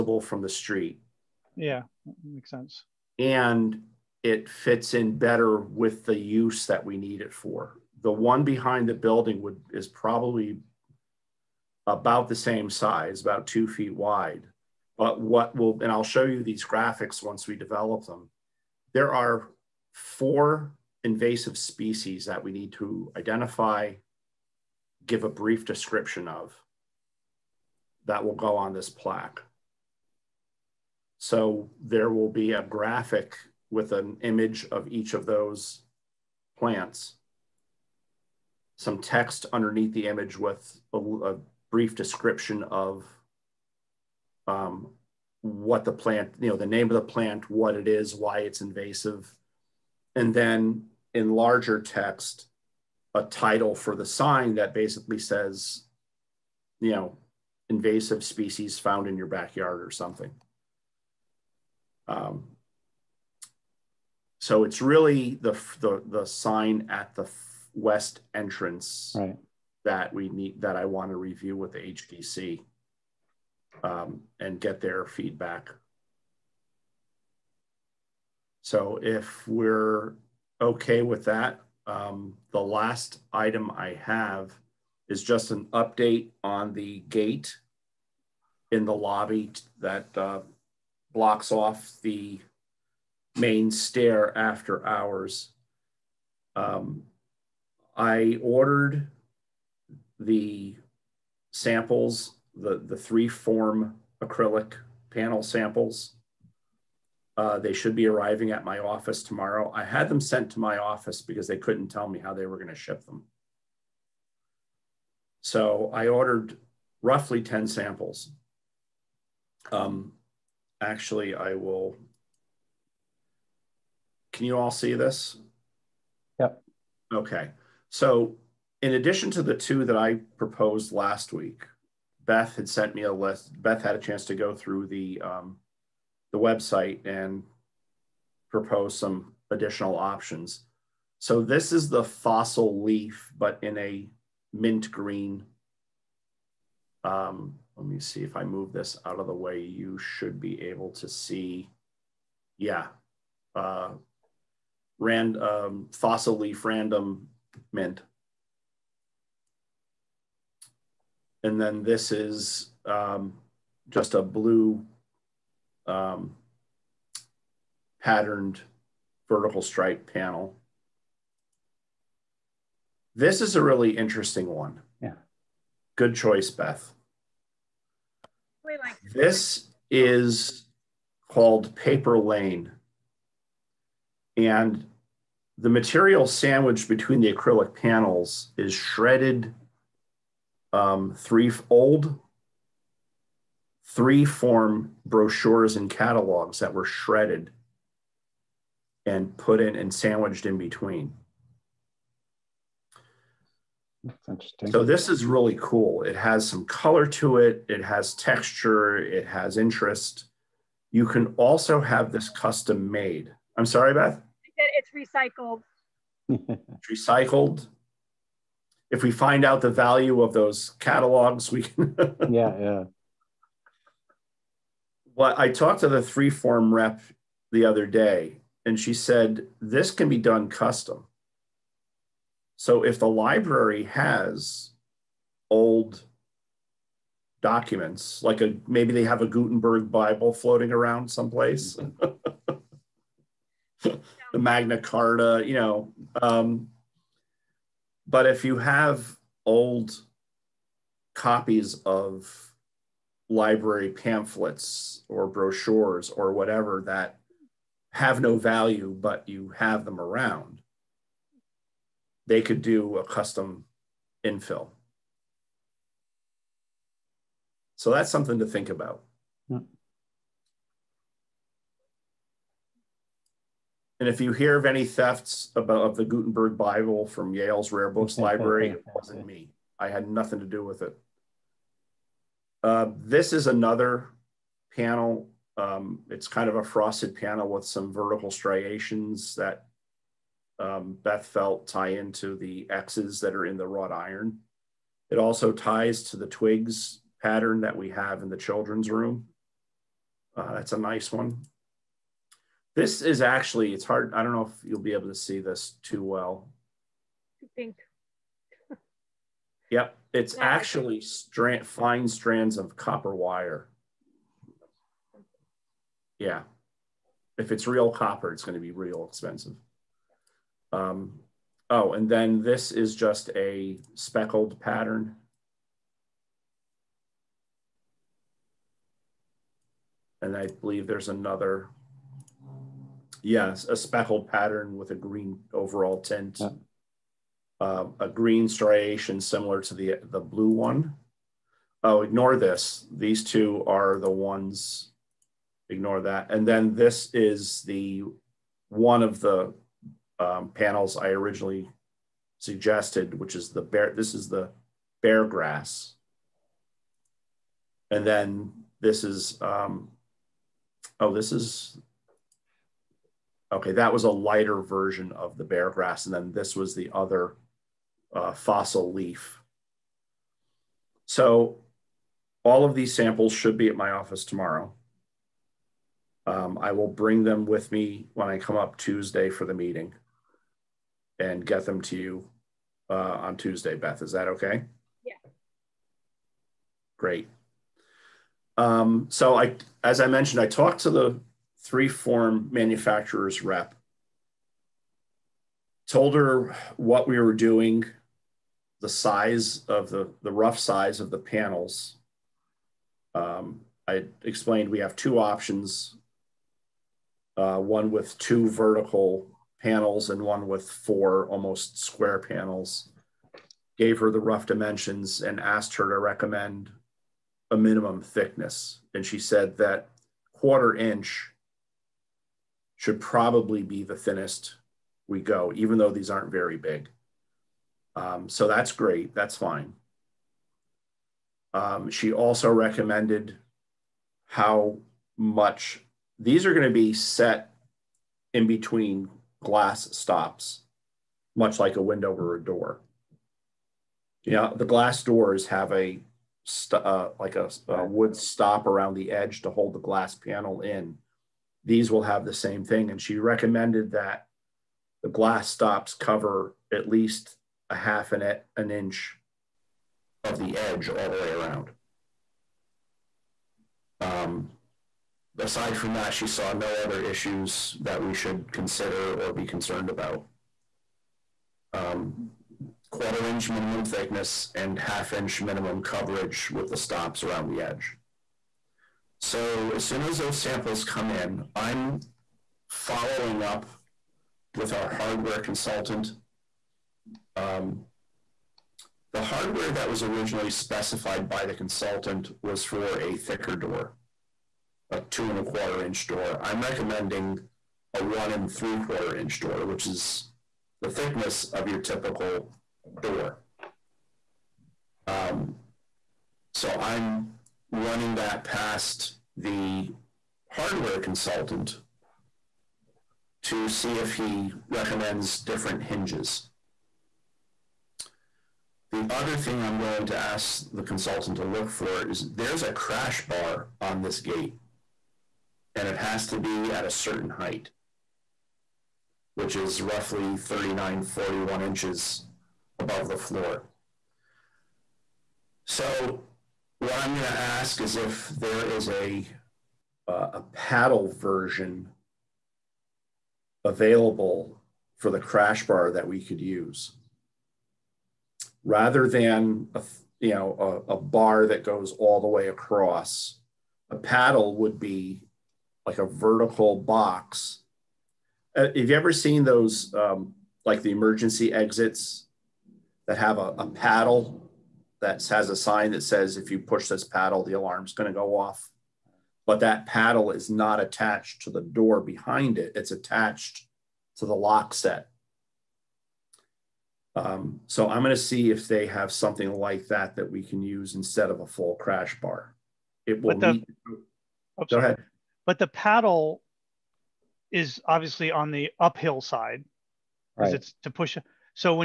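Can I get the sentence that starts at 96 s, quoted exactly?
Um, I ordered the samples, the, the three form acrylic panel samples uh, they should be arriving at my office tomorrow.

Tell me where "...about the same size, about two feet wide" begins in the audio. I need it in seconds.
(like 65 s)
11 s.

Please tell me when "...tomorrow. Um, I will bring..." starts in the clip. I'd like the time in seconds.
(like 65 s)
374 s.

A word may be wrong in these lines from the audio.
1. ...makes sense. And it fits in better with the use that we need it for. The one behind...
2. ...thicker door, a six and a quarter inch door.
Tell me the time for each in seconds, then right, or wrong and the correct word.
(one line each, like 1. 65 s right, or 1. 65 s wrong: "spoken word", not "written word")
1. 2 s right
2. 493 s wrong: "two", not "six".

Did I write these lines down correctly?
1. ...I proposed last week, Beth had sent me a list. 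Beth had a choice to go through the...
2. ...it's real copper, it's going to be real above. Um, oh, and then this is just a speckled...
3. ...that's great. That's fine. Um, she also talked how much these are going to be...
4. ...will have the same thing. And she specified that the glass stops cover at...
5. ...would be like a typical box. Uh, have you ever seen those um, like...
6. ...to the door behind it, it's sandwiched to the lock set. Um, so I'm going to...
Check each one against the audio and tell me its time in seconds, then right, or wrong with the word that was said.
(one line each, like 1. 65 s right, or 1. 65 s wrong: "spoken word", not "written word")
1. 129 s wrong: "chance", not "choice"
2. 317 s wrong: "expensive", not "above"
3. 428 s wrong: "recommended", not "talked"
4. 451 s wrong: "recommended", not "specified"
5. 554 s wrong: "vertical", not "typical"
6. 571 s wrong: "attached", not "sandwiched".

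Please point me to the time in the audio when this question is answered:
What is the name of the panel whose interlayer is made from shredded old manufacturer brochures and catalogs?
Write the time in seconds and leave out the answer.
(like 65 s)
181 s.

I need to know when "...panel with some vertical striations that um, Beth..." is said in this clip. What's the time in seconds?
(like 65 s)
287 s.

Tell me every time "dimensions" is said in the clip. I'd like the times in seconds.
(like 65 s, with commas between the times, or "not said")
414 s.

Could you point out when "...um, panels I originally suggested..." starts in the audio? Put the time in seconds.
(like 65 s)
350 s.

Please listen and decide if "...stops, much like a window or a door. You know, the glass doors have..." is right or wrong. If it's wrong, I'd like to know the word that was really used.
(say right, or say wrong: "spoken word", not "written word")
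right.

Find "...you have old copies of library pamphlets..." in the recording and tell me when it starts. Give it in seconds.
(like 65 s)
248 s.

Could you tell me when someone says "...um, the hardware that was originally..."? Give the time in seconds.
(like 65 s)
487 s.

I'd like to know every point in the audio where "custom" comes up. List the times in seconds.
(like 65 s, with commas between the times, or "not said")
212 s, 230 s, 263 s.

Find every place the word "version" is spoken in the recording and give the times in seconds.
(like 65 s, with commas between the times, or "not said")
364 s, 541 s.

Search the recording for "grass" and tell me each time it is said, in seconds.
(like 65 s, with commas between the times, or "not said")
355 s, 365 s.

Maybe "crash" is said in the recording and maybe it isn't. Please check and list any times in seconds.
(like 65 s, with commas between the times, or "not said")
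522 s, 545 s, 581 s.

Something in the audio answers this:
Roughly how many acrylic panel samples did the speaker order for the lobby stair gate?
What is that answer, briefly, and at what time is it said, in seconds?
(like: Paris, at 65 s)
10, at 117 s.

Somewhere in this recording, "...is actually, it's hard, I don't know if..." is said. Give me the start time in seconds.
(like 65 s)
303 s.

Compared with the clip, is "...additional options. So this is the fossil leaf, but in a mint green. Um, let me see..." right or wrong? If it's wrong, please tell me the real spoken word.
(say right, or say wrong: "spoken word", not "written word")
right.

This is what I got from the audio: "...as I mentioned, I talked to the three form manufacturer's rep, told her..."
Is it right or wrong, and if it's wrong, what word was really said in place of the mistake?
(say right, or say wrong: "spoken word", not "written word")
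right.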